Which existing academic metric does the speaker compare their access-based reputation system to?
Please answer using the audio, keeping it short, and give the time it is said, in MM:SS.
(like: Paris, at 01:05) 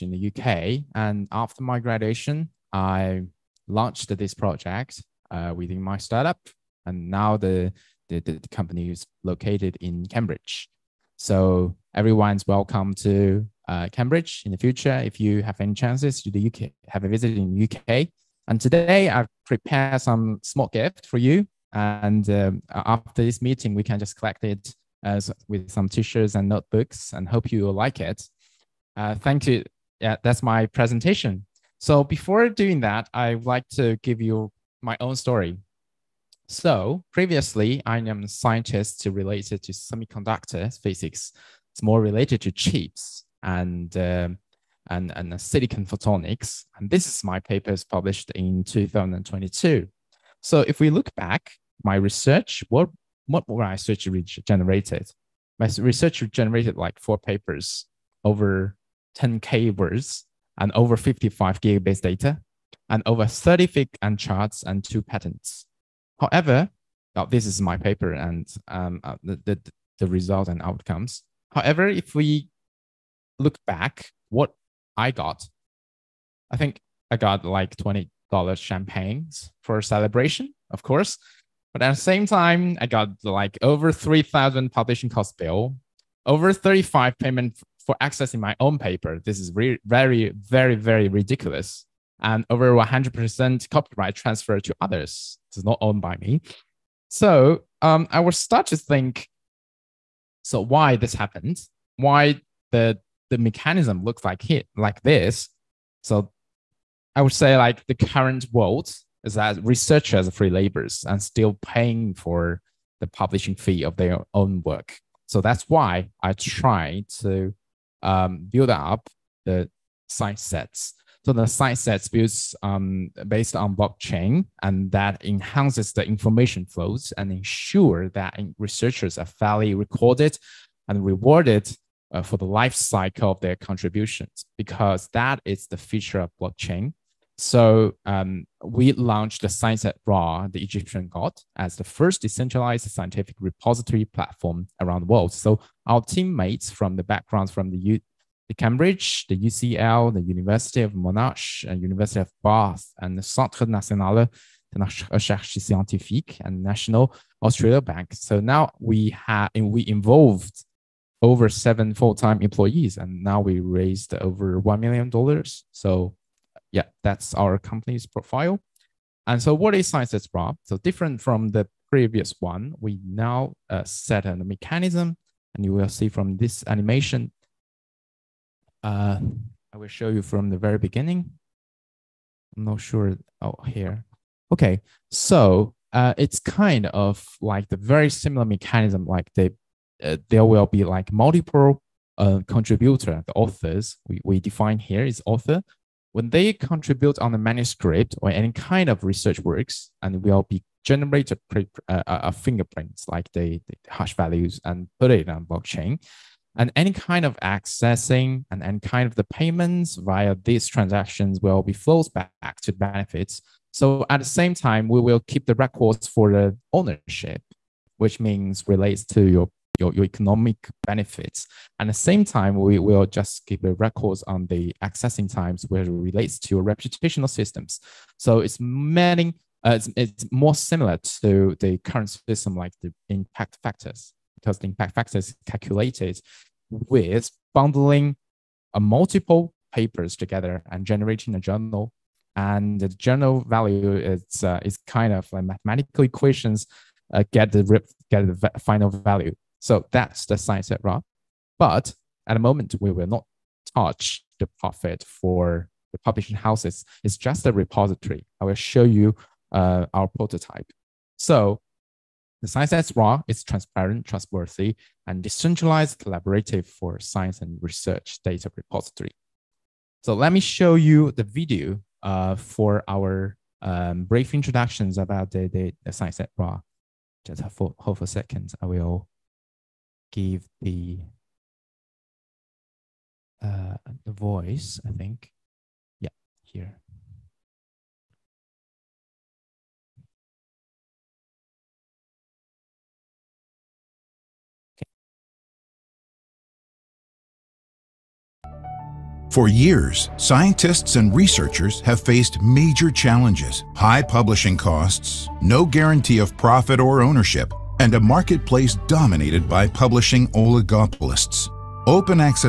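impact factor, at 03:53.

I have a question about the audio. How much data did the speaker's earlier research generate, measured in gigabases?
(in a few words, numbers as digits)
over 55 gigabases.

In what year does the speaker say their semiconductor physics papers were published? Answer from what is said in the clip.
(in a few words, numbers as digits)
2022.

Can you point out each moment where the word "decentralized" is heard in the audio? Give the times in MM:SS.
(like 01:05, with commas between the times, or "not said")
02:22, 04:25.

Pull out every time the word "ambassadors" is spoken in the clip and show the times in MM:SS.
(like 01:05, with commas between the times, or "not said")
not said.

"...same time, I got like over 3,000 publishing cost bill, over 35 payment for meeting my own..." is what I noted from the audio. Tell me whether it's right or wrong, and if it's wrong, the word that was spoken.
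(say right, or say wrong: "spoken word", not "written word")
wrong: "accessing", not "meeting".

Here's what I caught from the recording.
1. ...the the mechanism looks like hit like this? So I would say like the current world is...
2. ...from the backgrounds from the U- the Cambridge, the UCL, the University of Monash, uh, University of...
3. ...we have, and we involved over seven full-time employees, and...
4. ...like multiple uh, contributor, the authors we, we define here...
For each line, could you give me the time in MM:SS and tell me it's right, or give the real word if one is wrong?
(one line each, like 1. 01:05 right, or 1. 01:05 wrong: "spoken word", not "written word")
1. 01:42 right
2. 02:26 right
3. 02:38 right
4. 03:10 right.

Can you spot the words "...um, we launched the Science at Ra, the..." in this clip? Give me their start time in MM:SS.
02:18.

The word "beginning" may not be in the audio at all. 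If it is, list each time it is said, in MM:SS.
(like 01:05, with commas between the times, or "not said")
03:00.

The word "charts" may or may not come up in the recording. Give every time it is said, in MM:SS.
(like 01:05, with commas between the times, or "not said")
01:04.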